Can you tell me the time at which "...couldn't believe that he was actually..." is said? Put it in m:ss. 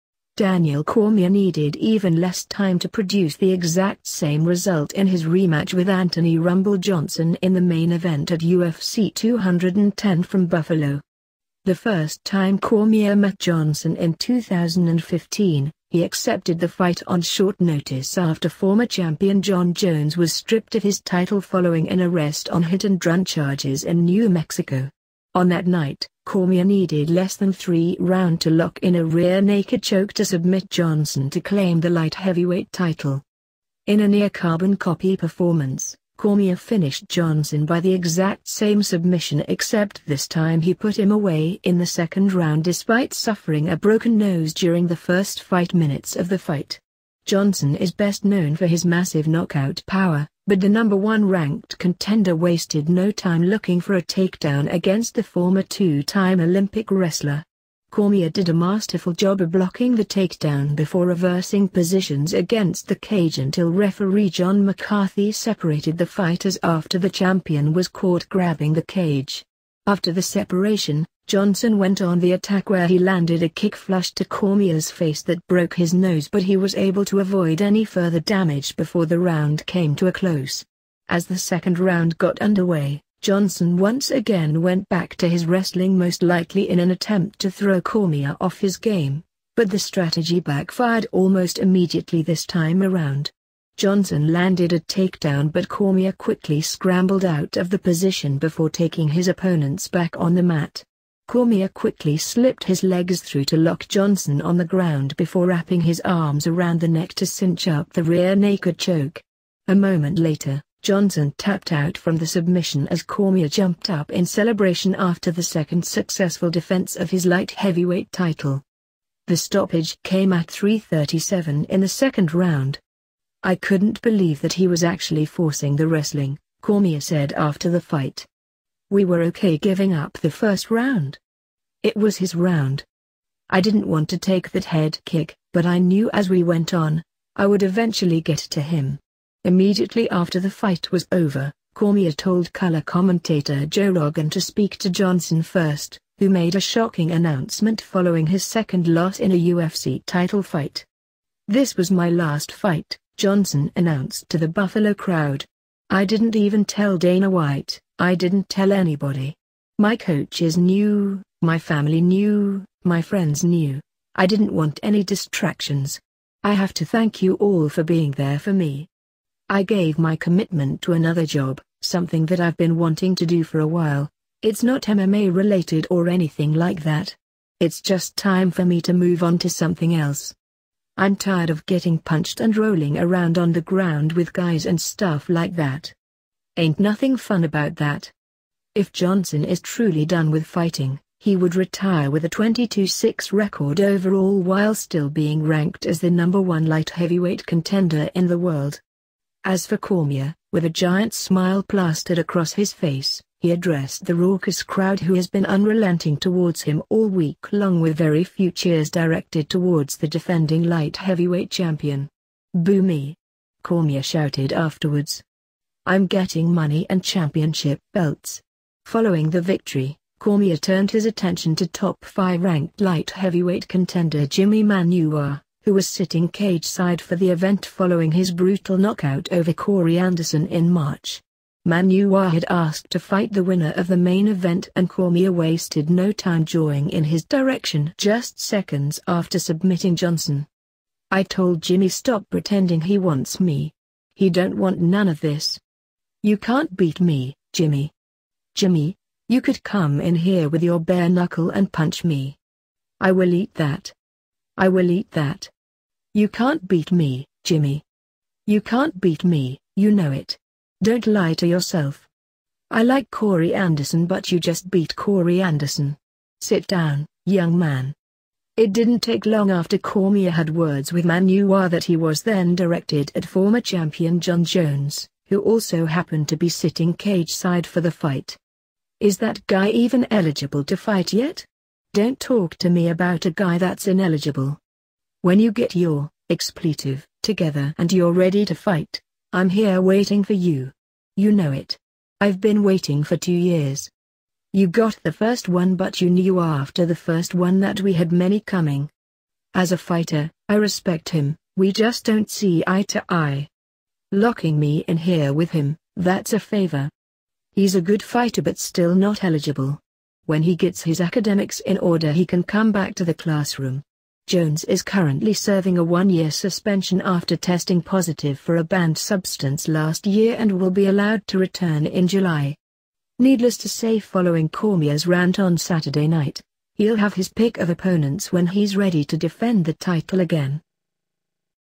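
2:03.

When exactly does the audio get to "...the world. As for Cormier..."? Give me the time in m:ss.
3:18.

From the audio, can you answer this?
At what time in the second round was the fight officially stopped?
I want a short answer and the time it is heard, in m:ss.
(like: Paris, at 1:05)
3:37, at 2:00.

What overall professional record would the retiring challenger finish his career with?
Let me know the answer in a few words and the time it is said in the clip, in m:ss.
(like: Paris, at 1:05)
22-6, at 3:12.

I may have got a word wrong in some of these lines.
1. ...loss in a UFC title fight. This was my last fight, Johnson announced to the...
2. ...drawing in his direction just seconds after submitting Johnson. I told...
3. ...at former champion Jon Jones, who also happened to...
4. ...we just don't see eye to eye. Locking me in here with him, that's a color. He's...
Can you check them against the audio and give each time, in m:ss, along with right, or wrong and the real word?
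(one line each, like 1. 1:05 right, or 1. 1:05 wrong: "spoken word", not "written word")
1. 2:28 right
2. 3:56 right
3. 4:33 right
4. 5:01 wrong: "favor", not "color".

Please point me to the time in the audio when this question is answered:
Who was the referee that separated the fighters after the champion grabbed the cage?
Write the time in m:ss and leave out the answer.
1:04.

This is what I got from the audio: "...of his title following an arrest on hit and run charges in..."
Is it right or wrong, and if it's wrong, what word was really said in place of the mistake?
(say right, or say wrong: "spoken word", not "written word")
right.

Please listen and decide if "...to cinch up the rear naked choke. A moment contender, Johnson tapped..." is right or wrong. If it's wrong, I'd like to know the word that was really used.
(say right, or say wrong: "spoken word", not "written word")
wrong: "later", not "contender".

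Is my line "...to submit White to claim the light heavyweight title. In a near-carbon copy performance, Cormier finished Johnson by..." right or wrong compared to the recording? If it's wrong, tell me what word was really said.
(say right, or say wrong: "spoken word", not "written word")
wrong: "Johnson", not "White".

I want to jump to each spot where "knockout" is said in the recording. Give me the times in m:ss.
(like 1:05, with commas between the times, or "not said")
0:49, 3:48.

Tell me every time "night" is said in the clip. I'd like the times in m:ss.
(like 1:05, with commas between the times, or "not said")
0:25, 5:26.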